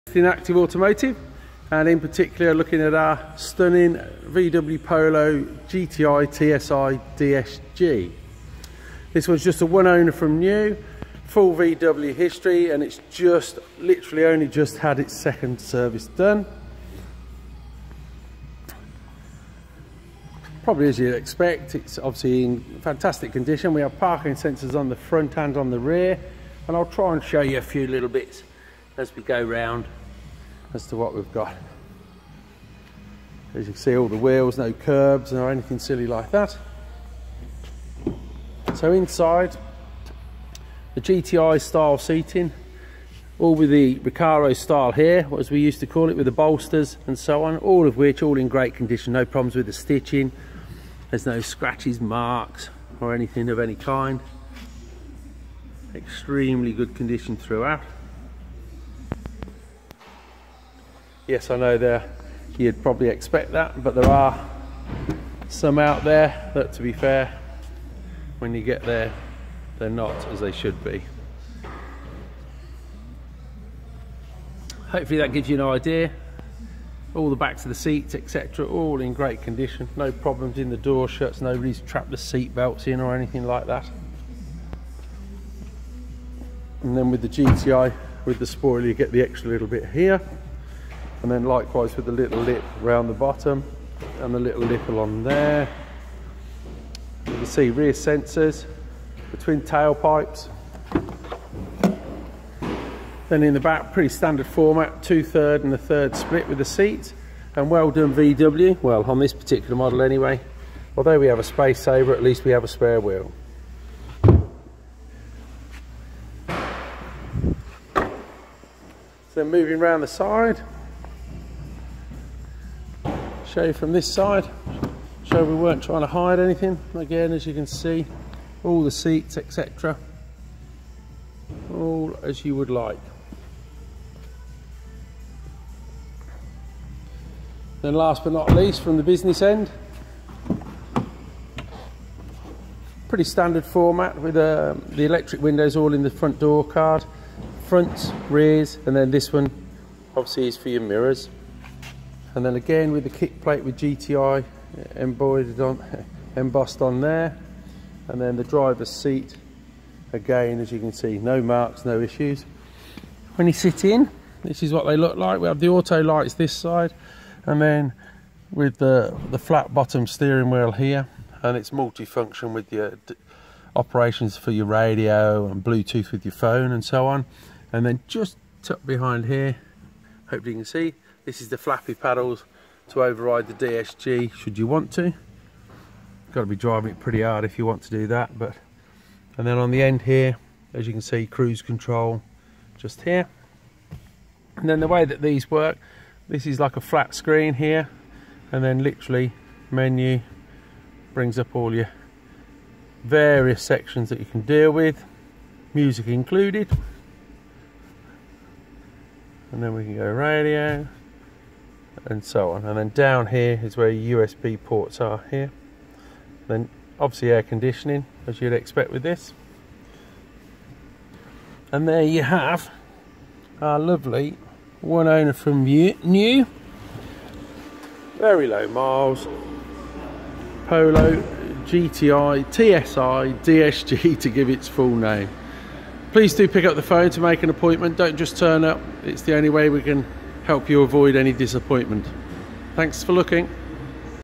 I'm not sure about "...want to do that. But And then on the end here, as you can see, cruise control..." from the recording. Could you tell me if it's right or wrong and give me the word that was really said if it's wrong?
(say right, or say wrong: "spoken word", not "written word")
right.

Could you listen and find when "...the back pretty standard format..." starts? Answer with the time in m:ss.
1:43.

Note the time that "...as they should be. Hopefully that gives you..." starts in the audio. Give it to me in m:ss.
1:10.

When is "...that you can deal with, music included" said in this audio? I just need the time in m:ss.
3:24.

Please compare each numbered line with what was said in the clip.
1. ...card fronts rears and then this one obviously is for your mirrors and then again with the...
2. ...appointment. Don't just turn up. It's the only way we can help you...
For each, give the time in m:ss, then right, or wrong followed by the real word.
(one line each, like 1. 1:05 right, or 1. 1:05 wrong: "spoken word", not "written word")
1. 2:26 right
2. 3:57 right.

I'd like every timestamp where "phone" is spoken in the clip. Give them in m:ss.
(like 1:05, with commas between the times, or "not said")
2:56, 3:56.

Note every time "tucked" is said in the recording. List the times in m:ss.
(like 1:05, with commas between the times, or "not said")
2:58.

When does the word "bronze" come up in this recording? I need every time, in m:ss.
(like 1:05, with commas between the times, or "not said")
not said.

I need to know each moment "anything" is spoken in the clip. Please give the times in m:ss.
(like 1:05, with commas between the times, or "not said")
0:35, 0:53, 1:23, 2:06.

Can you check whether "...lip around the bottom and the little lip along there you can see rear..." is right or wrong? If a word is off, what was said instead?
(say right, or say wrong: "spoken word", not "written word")
right.